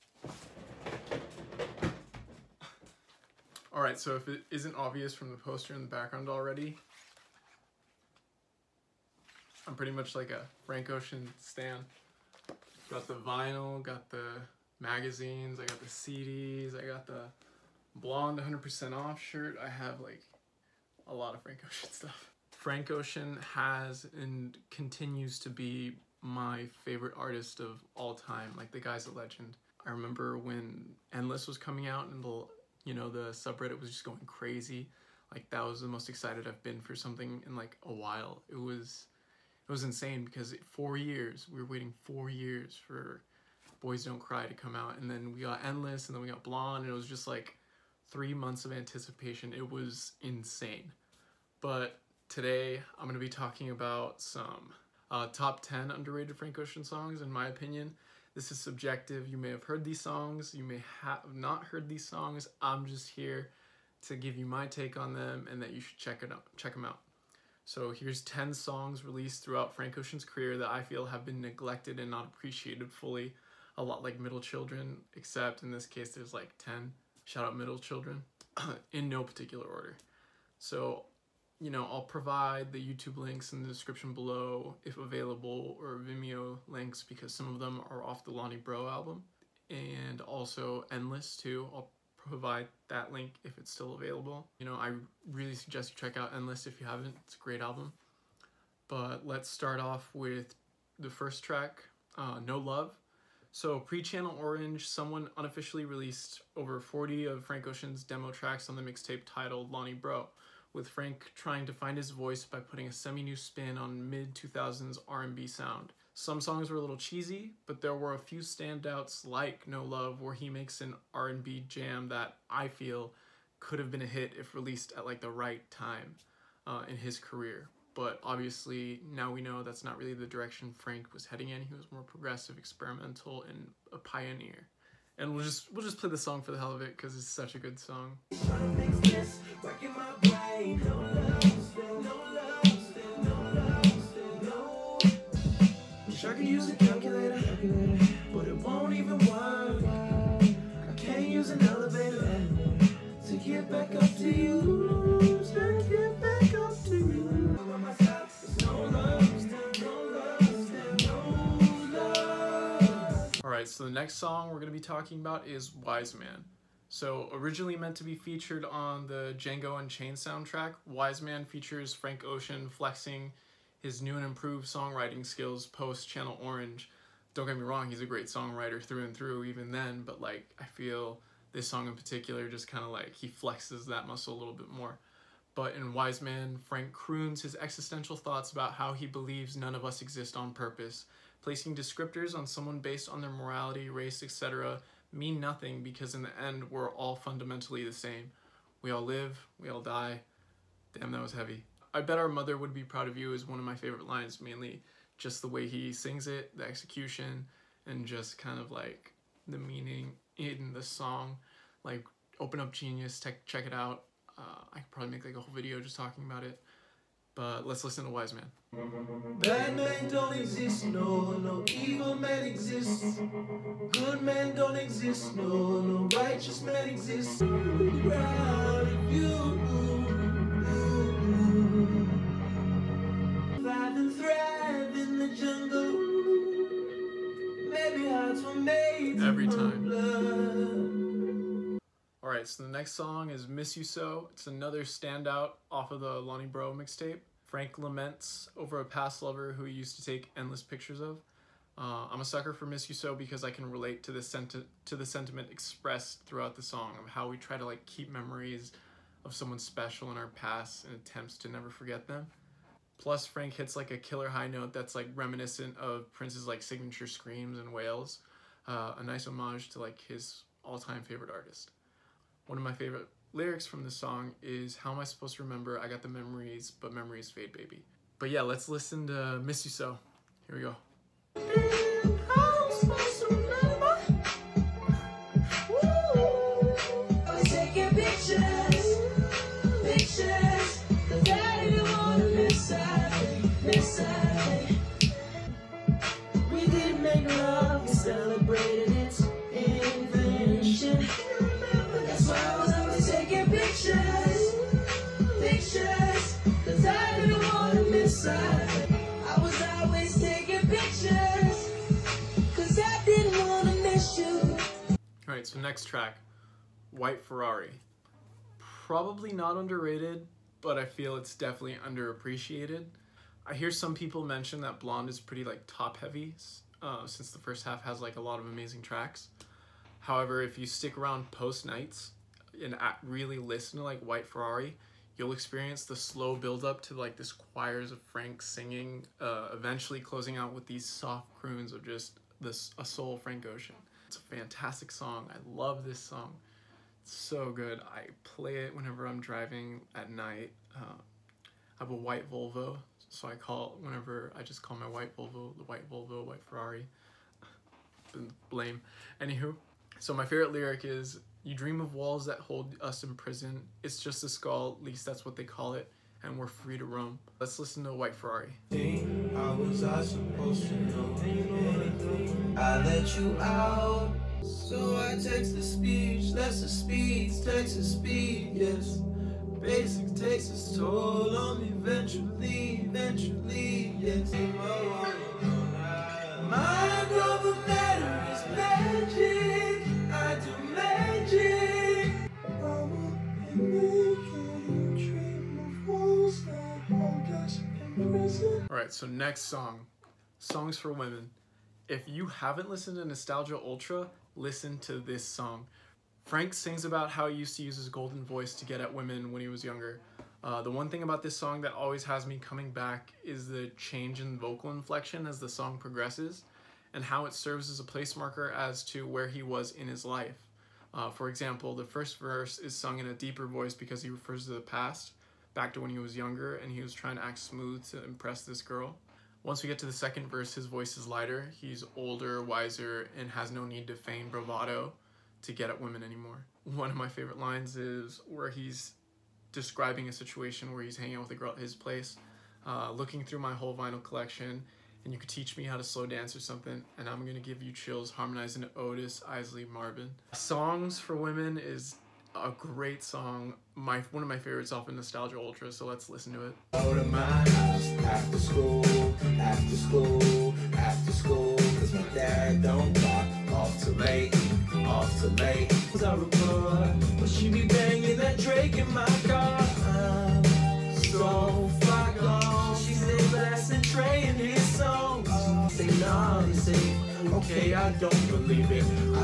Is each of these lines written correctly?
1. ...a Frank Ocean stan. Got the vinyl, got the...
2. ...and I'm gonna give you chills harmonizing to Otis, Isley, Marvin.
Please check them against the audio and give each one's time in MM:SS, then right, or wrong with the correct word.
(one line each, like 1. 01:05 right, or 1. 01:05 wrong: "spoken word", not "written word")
1. 00:10 right
2. 07:26 right.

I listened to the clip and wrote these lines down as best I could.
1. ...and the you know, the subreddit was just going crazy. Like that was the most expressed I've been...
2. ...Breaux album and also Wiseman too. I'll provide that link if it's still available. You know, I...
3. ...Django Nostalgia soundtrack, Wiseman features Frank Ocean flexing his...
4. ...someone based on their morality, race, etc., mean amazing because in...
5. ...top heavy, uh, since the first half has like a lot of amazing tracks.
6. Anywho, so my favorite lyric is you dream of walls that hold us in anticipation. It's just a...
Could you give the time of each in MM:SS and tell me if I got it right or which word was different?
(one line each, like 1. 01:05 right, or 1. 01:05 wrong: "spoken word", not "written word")
1. 00:32 wrong: "excited", not "expressed"
2. 01:28 wrong: "Endless", not "Wiseman"
3. 02:49 wrong: "Unchained", not "Nostalgia"
4. 03:12 wrong: "nothing", not "amazing"
5. 05:25 right
6. 05:59 wrong: "prison", not "anticipation".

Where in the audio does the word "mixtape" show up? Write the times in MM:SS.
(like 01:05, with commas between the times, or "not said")
01:48, 04:06.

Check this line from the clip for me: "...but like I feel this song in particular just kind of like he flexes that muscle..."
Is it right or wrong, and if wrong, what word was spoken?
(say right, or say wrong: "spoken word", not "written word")
right.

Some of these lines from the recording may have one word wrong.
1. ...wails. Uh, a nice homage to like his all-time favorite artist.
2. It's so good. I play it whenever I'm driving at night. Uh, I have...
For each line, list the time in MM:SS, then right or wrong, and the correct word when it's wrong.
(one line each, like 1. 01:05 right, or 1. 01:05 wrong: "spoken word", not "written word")
1. 04:27 right
2. 05:47 right.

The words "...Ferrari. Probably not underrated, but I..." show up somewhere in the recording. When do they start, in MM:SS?
05:17.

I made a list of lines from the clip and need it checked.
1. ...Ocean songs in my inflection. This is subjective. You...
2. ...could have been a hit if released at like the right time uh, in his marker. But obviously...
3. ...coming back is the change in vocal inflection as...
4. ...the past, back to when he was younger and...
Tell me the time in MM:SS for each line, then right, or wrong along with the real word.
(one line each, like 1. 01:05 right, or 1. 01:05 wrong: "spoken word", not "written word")
1. 00:56 wrong: "opinion", not "inflection"
2. 02:03 wrong: "career", not "marker"
3. 06:52 right
4. 07:04 right.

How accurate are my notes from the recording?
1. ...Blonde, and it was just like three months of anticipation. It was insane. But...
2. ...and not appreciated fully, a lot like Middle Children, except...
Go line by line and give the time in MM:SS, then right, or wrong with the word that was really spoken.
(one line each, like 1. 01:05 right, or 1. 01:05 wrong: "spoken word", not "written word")
1. 00:46 right
2. 01:12 right.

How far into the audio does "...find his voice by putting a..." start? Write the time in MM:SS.
01:51.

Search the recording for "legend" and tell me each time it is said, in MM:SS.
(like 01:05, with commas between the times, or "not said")
00:29.